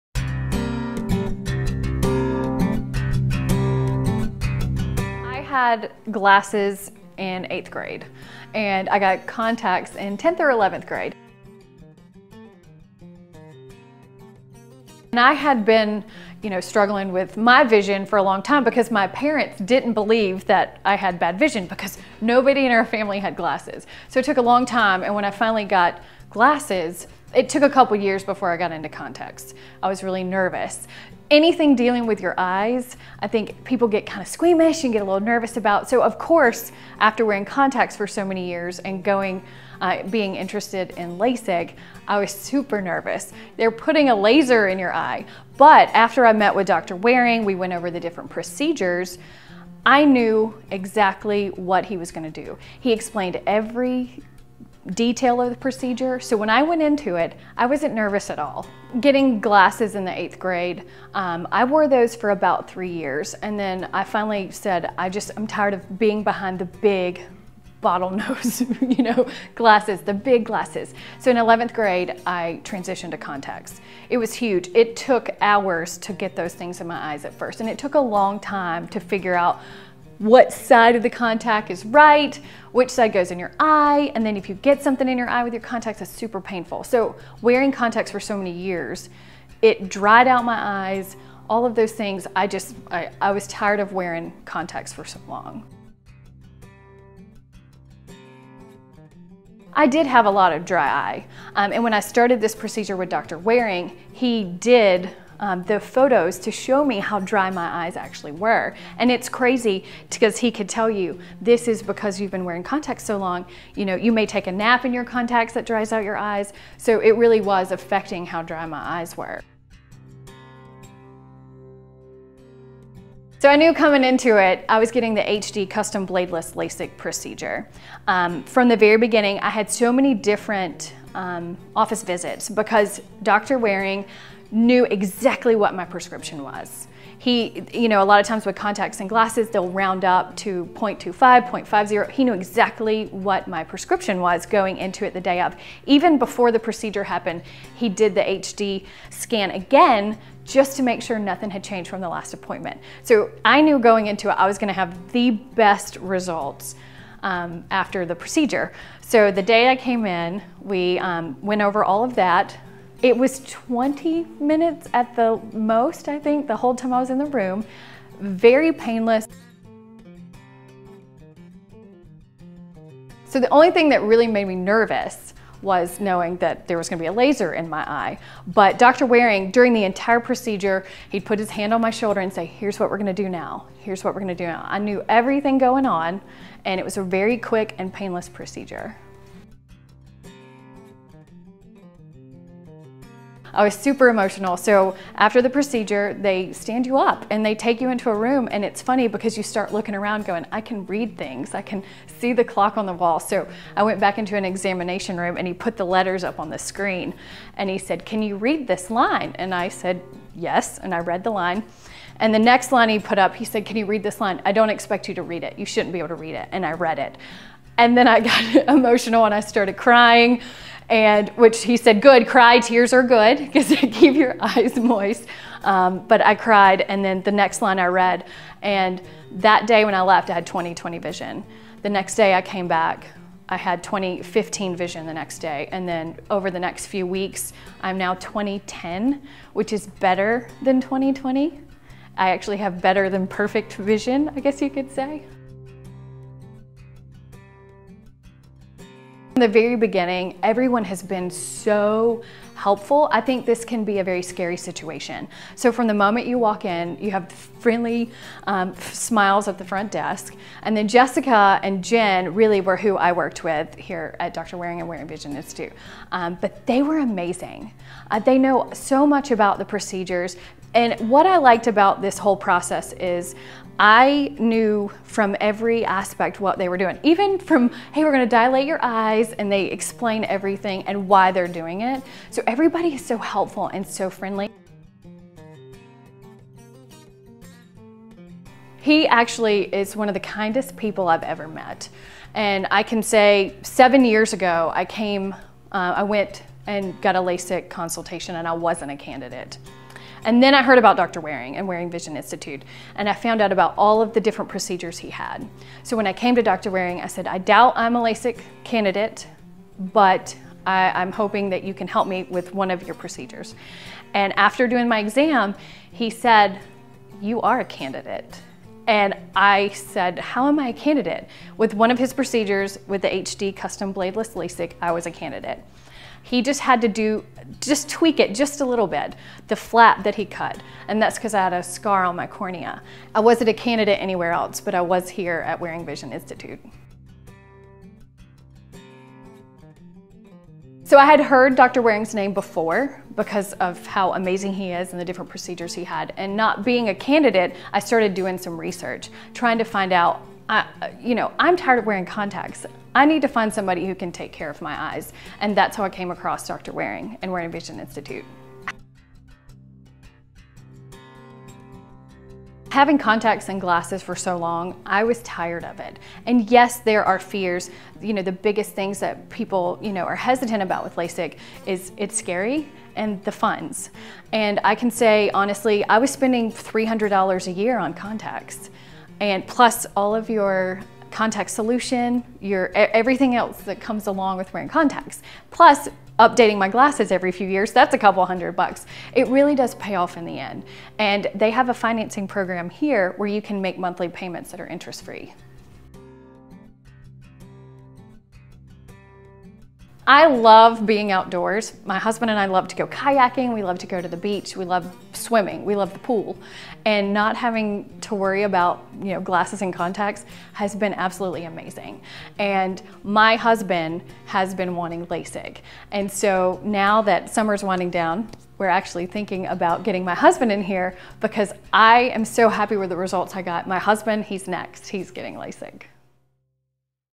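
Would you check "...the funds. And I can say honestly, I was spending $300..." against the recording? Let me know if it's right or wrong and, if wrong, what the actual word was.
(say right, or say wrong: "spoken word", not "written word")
right.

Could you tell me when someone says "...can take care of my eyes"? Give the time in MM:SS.
05:53.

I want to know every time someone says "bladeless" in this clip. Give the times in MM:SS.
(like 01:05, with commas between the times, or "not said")
02:06, 05:23.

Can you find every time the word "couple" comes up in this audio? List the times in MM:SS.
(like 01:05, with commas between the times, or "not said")
00:27, 06:27.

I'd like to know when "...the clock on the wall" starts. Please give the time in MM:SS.
03:22.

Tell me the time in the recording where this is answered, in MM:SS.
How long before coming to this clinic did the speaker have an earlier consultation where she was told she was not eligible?
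04:53.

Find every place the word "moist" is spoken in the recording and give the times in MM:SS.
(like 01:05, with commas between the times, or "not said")
03:44.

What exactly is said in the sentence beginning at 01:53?
You know, you may take a nap in your contacts that dries out your eyes.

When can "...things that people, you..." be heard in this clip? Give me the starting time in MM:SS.
06:08.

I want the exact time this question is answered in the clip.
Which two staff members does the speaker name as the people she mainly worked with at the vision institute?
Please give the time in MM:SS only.
04:20.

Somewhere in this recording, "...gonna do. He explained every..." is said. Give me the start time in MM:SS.
00:52.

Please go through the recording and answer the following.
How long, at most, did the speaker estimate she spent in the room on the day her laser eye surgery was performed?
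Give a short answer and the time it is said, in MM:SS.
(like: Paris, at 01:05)
20 minutes, at 02:43.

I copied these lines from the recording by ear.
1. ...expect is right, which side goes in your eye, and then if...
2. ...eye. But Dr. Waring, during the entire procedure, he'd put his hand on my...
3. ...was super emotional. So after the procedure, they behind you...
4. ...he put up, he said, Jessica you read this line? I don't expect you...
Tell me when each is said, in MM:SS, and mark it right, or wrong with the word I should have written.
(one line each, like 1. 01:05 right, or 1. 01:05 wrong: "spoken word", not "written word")
1. 01:21 wrong: "contact", not "expect"
2. 02:57 right
3. 03:13 wrong: "stand", not "behind"
4. 03:32 wrong: "Can", not "Jessica".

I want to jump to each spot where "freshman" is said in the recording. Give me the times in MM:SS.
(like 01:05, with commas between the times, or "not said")
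not said.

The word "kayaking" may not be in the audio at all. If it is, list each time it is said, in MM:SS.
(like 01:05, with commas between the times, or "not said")
06:42.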